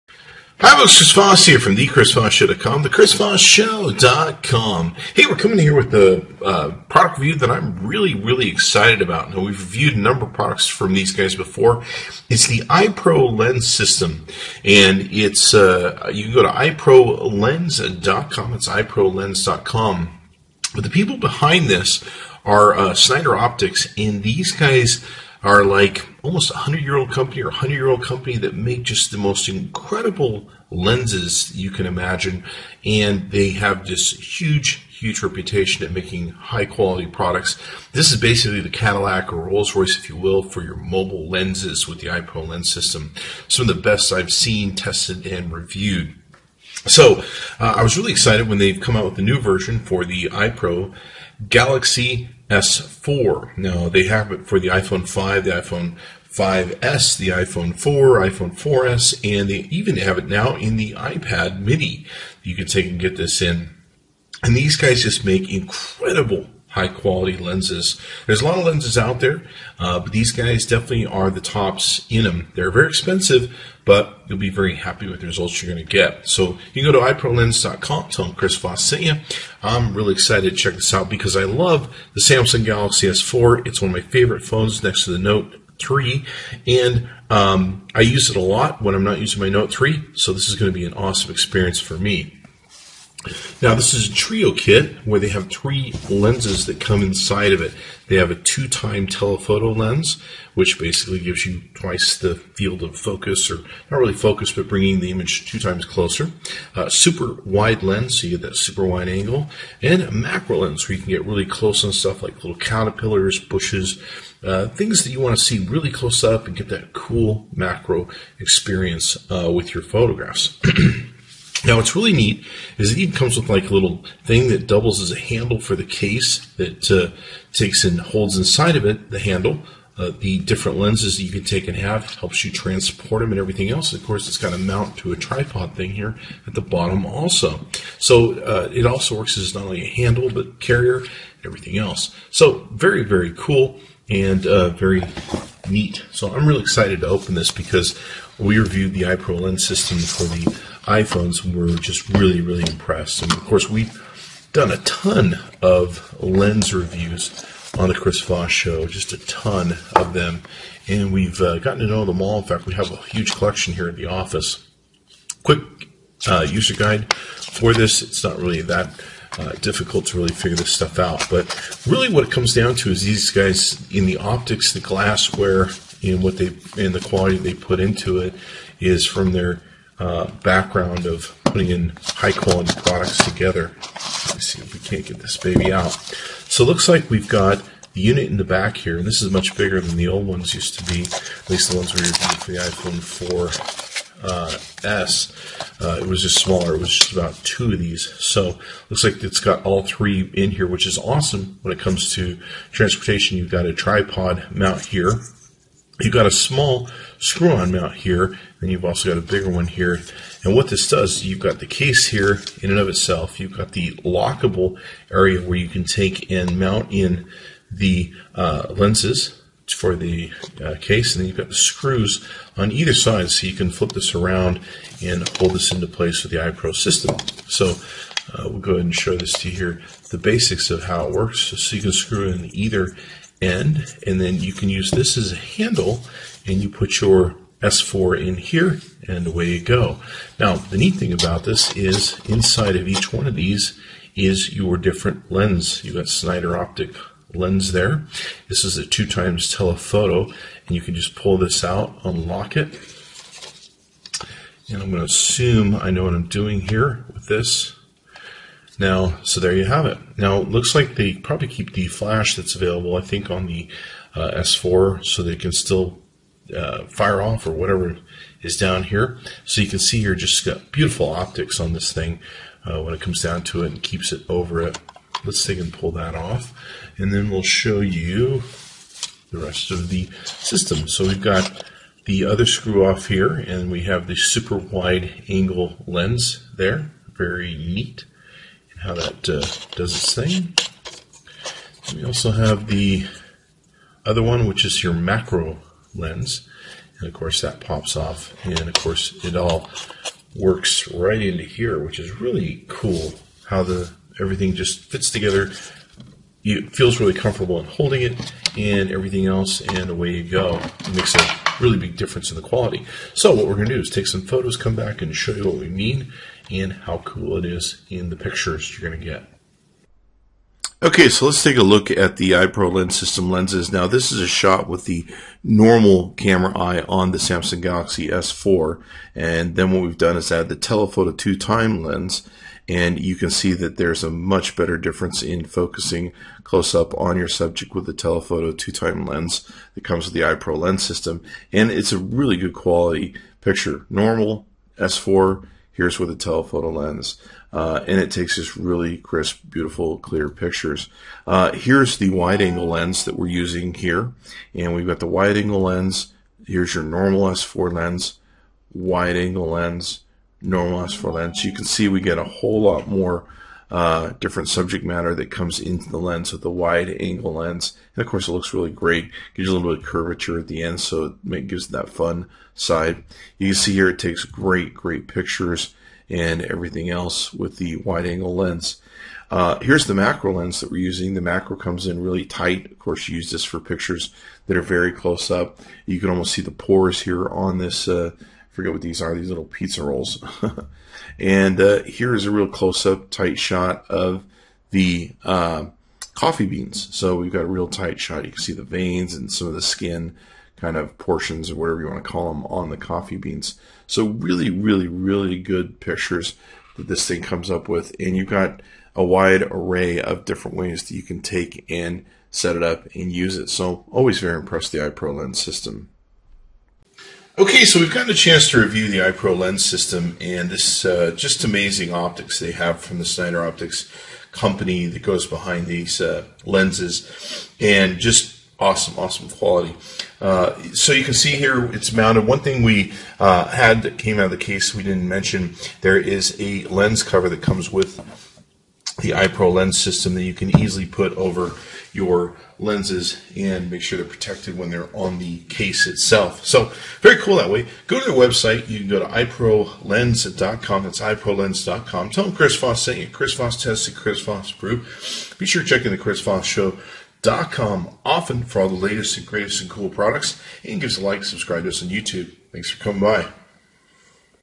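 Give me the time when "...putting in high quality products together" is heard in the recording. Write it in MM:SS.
03:01.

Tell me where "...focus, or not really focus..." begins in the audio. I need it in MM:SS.
01:42.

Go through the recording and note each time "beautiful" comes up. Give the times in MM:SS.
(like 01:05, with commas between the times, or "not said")
04:30, 05:49.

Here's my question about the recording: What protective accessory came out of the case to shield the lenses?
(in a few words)
lens cover.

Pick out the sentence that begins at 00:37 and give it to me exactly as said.
This is basically the Cadillac or Rolls Royce, if you will, for your mobile lenses with the iPro lens system.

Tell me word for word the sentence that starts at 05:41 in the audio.
And it's a really good quality picture.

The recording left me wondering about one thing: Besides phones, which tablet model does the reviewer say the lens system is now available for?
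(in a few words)
iPad mini.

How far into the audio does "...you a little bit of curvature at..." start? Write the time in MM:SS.
06:09.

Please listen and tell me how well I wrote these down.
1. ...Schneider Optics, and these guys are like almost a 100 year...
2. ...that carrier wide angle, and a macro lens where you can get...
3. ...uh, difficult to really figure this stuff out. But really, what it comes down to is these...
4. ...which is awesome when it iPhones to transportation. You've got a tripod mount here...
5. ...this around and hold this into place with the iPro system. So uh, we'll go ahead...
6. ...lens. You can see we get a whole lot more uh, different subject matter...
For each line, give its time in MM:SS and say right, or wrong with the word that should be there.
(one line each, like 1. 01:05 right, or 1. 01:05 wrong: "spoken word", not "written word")
1. 00:22 right
2. 01:48 wrong: "super", not "carrier"
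3. 02:49 right
4. 03:20 wrong: "comes", not "iPhones"
5. 03:43 right
6. 06:01 right.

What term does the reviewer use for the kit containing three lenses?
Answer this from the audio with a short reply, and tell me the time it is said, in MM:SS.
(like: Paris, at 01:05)
trio kit, at 01:34.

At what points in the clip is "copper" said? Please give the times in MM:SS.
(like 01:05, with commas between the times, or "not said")
not said.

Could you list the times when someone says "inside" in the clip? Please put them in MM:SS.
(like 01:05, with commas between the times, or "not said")
01:37, 02:08, 04:02.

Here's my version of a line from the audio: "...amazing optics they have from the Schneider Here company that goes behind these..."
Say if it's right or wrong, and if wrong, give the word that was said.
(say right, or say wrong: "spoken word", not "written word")
wrong: "Optics", not "Here".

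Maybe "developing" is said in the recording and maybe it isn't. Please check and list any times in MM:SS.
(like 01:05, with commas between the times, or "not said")
not said.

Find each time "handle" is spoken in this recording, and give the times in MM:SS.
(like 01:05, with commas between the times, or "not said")
02:05, 02:09, 02:19, 03:55.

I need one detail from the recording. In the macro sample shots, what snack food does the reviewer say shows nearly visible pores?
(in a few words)
pizza rolls.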